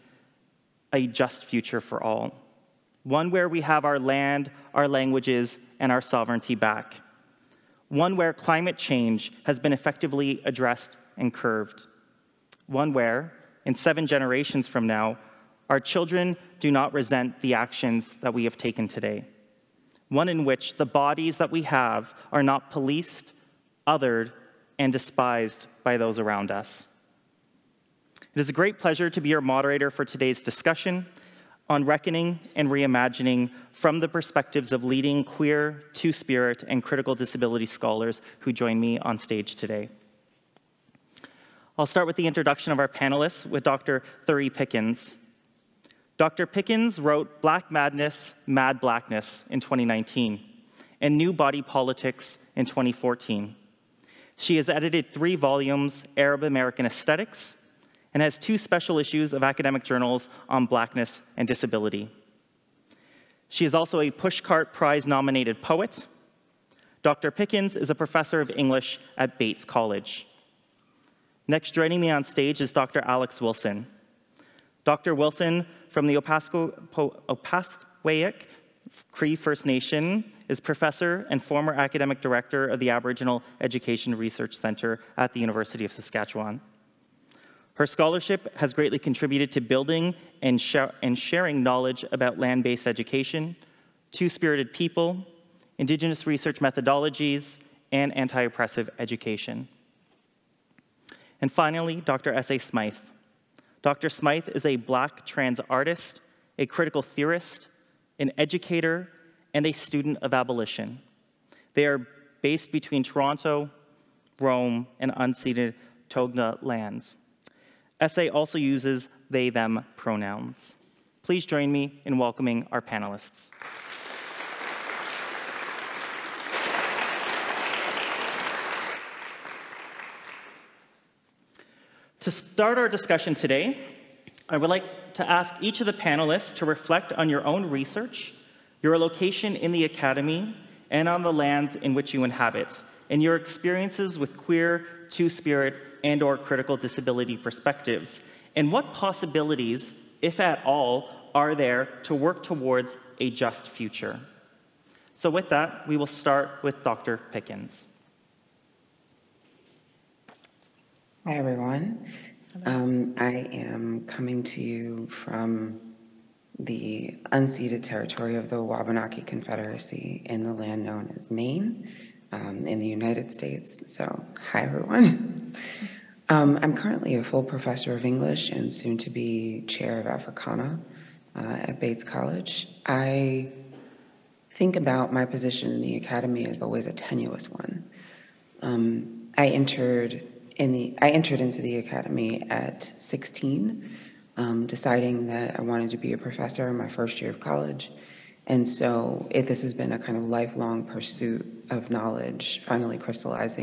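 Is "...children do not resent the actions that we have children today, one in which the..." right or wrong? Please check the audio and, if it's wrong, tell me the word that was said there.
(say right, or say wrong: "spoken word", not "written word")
wrong: "taken", not "children".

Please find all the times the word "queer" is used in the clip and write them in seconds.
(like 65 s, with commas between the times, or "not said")
35 s, 144 s.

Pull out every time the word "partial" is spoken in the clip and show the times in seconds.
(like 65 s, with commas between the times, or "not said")
not said.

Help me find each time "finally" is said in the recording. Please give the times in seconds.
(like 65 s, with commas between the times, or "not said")
101 s, 202 s.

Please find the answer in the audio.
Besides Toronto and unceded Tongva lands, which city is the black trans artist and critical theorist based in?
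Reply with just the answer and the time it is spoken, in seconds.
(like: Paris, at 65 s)
Rome, at 114 s.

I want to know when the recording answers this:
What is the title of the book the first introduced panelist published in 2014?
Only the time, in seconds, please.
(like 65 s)
51 s.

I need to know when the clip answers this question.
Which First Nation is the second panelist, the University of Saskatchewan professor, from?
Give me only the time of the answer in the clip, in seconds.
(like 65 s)
76 s.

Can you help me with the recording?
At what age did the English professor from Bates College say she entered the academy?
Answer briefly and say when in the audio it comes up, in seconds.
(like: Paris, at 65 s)
16, at 192 s.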